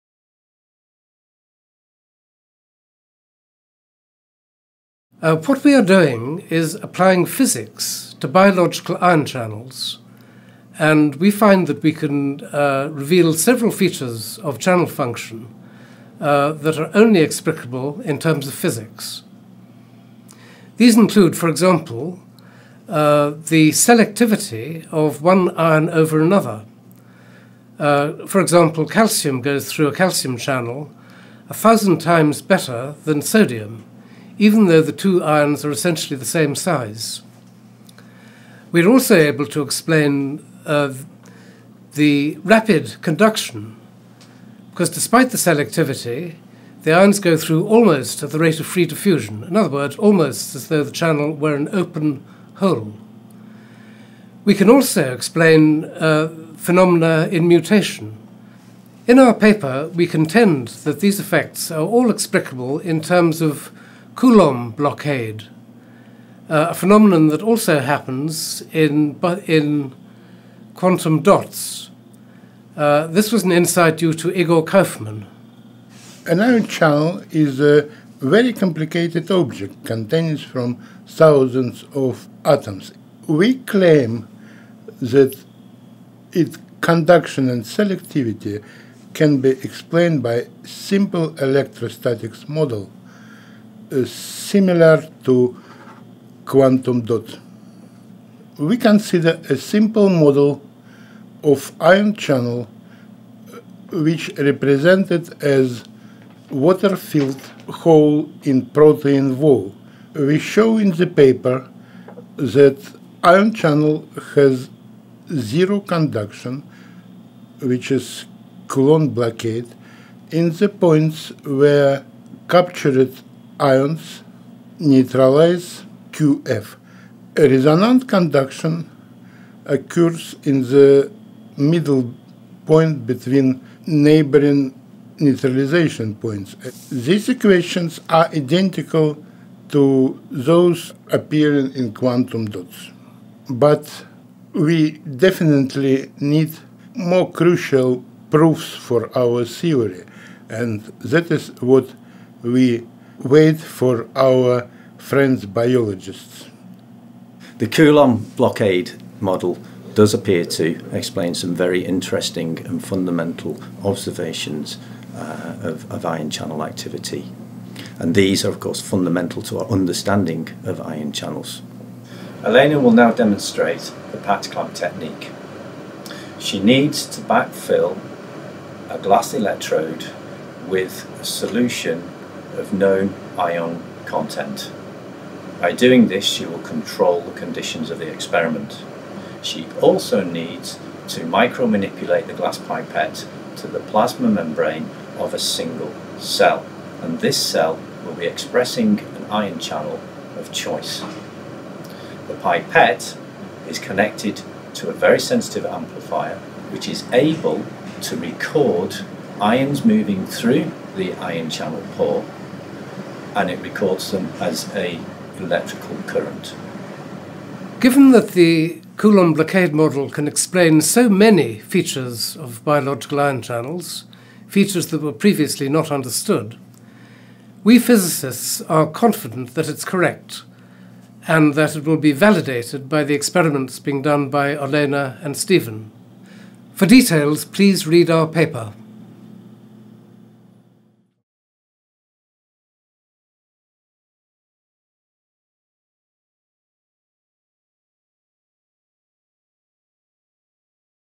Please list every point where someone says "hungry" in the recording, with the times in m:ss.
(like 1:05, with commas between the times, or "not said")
not said.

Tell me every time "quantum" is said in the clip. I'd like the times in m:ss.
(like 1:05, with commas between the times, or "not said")
1:10, 1:36, 2:21.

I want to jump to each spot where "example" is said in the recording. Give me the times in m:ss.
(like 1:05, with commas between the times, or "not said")
0:21, 0:28.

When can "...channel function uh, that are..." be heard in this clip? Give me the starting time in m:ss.
0:14.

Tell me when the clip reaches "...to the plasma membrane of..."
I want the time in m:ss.
3:13.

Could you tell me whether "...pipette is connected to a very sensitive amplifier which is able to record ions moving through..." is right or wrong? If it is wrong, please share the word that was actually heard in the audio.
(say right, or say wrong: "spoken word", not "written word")
right.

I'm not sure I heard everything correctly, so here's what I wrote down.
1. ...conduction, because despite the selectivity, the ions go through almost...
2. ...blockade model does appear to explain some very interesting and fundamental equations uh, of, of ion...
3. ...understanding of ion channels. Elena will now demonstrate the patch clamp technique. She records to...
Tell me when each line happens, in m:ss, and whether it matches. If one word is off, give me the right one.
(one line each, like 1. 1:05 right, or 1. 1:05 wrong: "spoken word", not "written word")
1. 0:43 right
2. 2:38 wrong: "observations", not "equations"
3. 2:49 wrong: "needs", not "records".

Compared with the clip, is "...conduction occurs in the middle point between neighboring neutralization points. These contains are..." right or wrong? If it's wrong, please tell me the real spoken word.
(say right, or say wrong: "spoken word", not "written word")
wrong: "equations", not "contains".